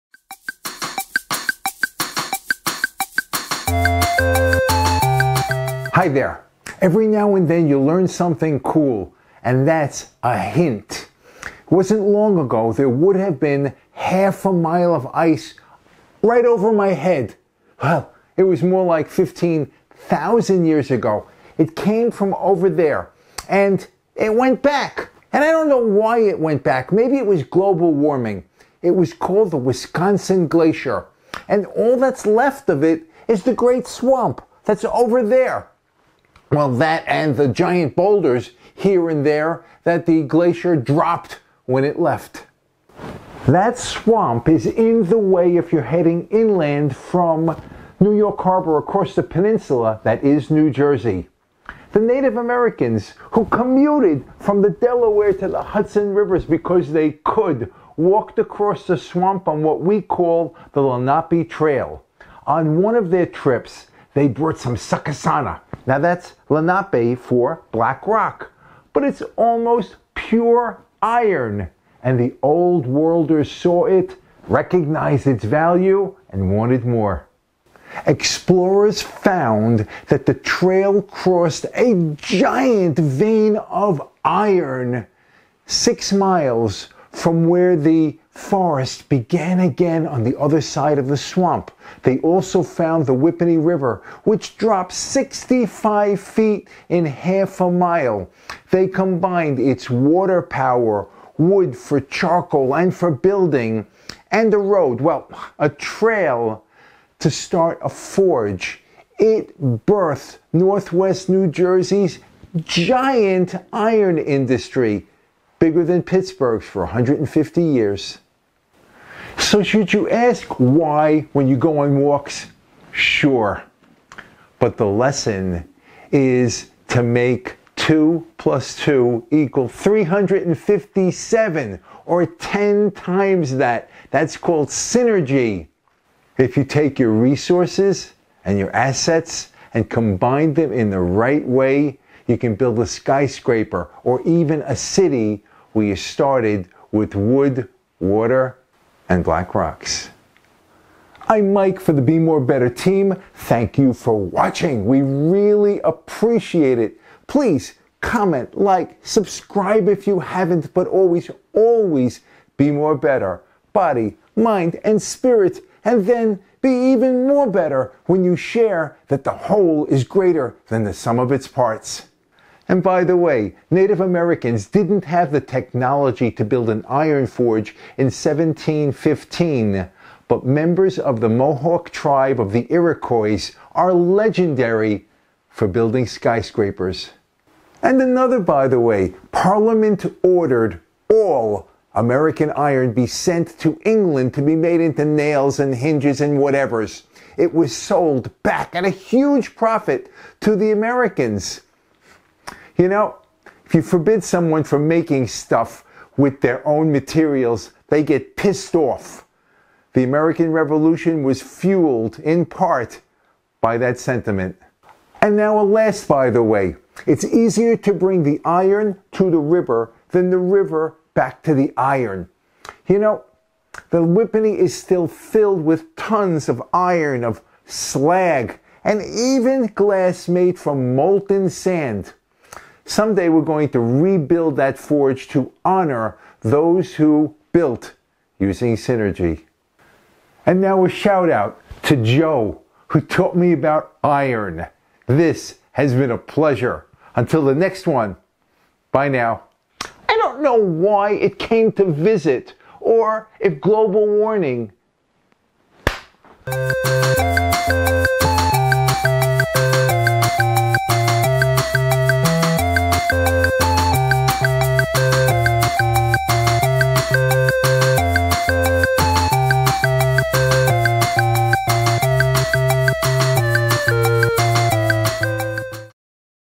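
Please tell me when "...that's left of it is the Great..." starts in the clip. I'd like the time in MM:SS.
00:31.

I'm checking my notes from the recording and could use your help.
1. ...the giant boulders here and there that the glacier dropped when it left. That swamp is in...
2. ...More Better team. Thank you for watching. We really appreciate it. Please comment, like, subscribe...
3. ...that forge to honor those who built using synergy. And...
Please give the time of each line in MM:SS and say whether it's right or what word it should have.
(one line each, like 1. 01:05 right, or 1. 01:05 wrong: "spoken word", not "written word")
1. 00:37 right
2. 02:32 right
3. 03:54 right.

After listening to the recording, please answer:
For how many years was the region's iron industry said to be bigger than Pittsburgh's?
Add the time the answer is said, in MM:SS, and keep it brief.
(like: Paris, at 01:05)
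150 years, at 01:56.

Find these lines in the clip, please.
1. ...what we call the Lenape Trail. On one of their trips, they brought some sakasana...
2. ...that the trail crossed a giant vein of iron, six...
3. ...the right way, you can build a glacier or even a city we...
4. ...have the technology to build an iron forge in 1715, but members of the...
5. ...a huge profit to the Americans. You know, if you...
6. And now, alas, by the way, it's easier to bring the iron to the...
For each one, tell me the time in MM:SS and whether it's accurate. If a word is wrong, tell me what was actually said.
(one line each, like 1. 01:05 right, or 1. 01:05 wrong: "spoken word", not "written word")
1. 00:59 right
2. 01:20 right
3. 02:20 wrong: "skyscraper", not "glacier"
4. 02:55 right
5. 03:18 right
6. 03:35 right.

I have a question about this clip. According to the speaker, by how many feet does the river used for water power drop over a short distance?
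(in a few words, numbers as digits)
65 feet.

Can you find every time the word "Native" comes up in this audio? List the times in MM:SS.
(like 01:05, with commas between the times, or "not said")
00:52, 02:53.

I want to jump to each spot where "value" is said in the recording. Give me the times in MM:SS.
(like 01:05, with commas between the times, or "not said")
01:15.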